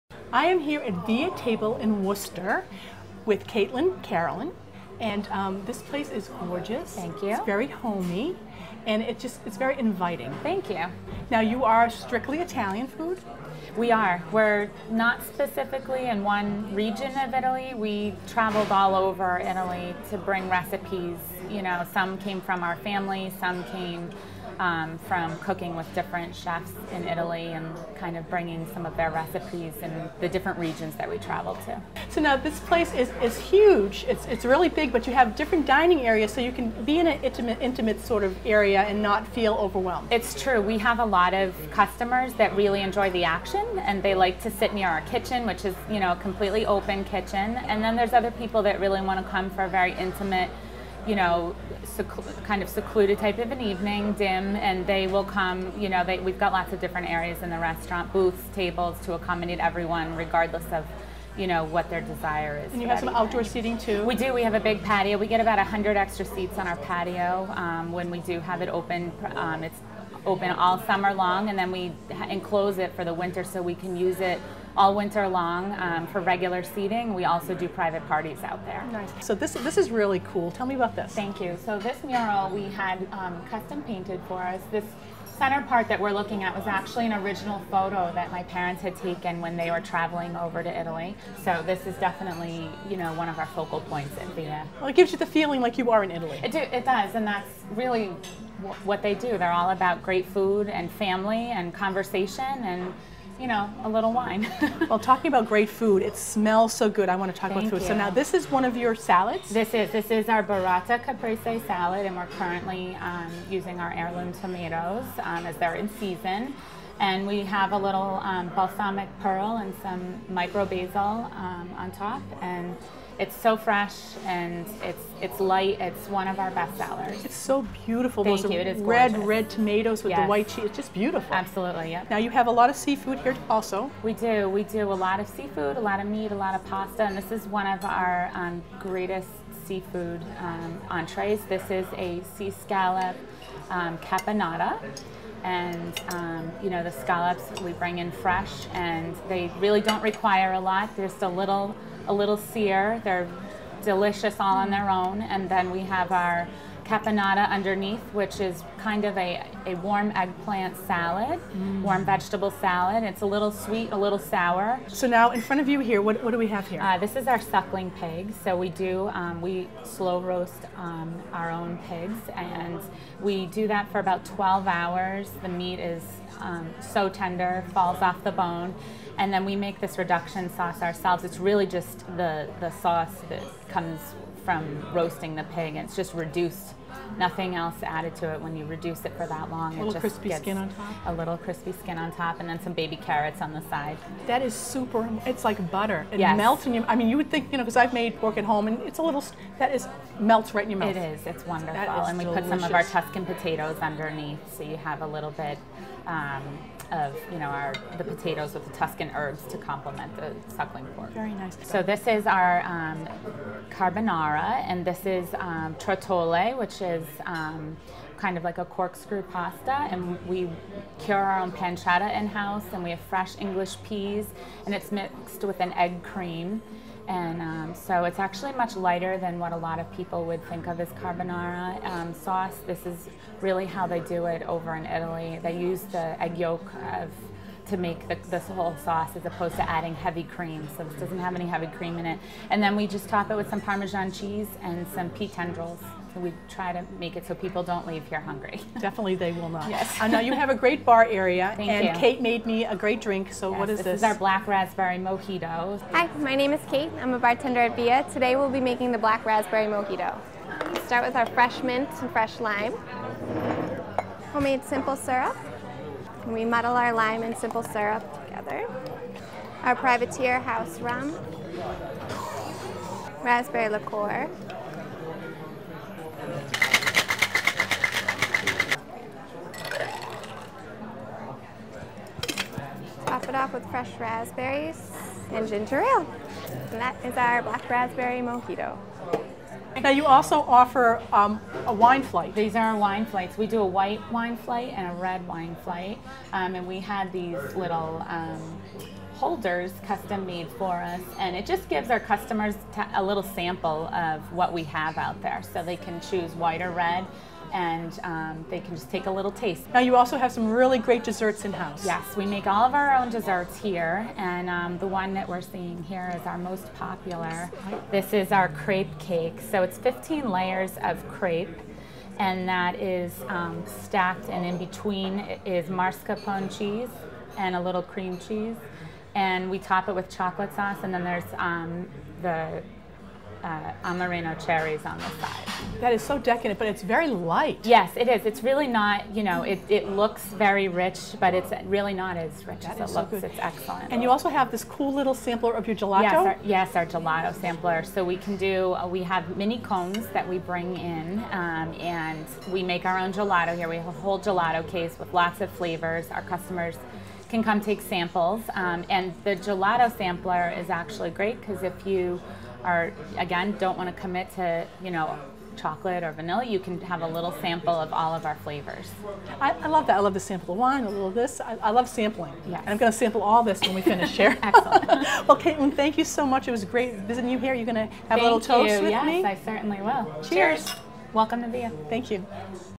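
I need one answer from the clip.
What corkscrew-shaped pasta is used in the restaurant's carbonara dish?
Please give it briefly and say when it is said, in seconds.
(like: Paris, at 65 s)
trottole, at 215 s.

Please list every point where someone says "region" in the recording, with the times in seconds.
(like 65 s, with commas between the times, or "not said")
16 s, 30 s.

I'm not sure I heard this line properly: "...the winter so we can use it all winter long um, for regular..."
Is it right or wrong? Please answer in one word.
right.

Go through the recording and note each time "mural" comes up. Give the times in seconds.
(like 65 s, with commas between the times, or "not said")
82 s.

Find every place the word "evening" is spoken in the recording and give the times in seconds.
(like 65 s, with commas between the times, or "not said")
53 s, 63 s.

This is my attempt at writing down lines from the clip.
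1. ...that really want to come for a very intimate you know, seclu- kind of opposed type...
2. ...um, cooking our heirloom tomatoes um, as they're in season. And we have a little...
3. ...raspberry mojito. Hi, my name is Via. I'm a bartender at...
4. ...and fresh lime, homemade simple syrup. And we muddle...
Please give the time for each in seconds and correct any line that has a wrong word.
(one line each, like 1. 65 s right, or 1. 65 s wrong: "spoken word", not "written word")
1. 48 s wrong: "secluded", not "opposed"
2. 113 s wrong: "using", not "cooking"
3. 254 s wrong: "Kate", not "Via"
4. 262 s right.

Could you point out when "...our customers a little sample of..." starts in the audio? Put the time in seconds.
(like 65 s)
301 s.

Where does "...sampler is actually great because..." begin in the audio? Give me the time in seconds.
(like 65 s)
359 s.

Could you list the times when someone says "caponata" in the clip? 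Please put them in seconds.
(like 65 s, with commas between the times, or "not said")
143 s, 156 s.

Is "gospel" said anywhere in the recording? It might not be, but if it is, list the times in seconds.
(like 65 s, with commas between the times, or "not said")
not said.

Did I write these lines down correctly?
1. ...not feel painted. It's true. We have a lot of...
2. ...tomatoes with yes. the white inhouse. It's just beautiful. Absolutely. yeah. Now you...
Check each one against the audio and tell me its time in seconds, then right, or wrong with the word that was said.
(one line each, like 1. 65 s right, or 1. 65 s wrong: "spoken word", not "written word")
1. 39 s wrong: "overwhelmed", not "painted"
2. 129 s wrong: "cheese", not "inhouse".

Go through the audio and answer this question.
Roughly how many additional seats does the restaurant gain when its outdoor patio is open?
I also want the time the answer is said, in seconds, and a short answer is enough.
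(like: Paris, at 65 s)
100, at 65 s.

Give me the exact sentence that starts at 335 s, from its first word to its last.
That is so decadent, but it's very light.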